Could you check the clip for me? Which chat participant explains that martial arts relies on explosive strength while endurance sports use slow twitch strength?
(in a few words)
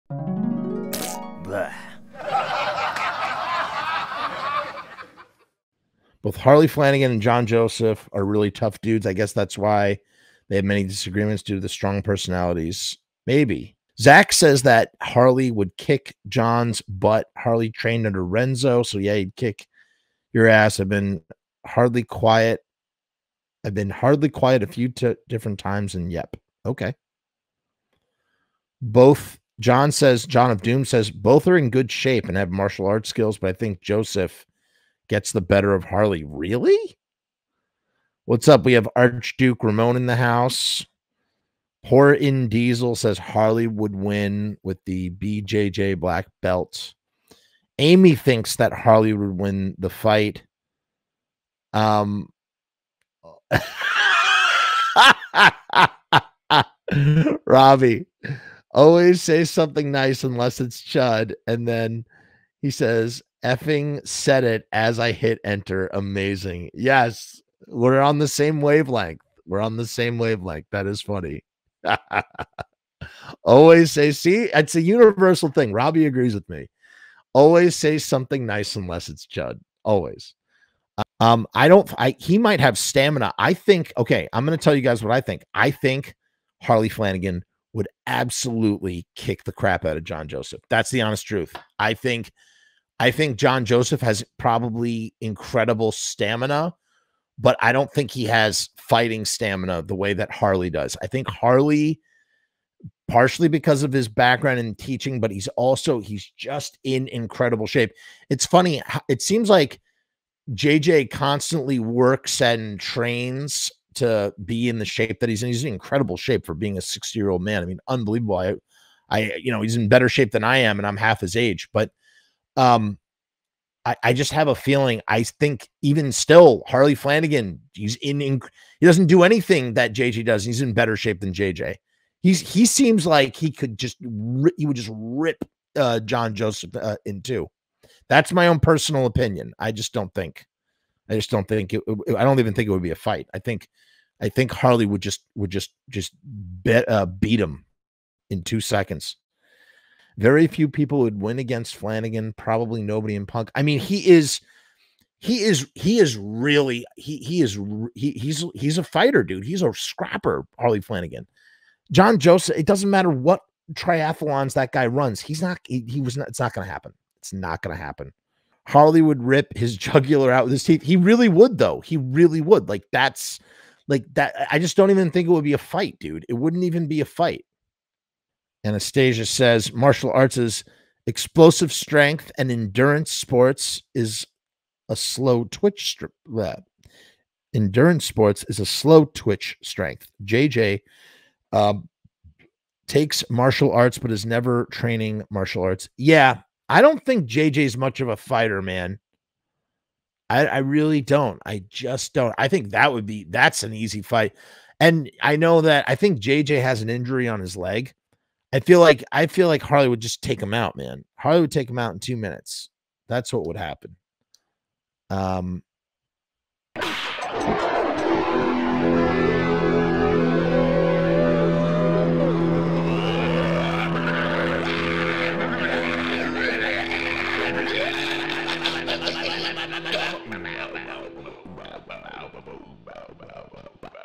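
Anastasia.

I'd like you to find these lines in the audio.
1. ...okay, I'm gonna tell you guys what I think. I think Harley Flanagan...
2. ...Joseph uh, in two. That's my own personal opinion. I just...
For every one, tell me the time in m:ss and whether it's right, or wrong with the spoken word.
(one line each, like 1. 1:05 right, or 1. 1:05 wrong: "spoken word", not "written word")
1. 1:23 right
2. 2:16 right.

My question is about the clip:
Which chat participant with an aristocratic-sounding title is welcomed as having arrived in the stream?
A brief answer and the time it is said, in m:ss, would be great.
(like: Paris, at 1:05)
Archduke Ramon, at 0:38.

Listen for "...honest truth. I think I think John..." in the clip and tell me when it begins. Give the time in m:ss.
1:31.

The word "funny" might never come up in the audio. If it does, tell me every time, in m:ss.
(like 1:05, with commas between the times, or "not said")
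1:11, 1:48.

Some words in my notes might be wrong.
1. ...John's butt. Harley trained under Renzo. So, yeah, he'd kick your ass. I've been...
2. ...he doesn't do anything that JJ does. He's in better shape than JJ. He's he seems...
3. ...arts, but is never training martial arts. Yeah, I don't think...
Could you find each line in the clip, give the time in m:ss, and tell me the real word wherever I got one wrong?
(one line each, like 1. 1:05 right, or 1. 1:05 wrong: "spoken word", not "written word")
1. 0:16 right
2. 2:08 right
3. 3:13 right.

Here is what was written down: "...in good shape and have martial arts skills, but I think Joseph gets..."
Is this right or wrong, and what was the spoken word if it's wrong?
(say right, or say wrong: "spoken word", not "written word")
right.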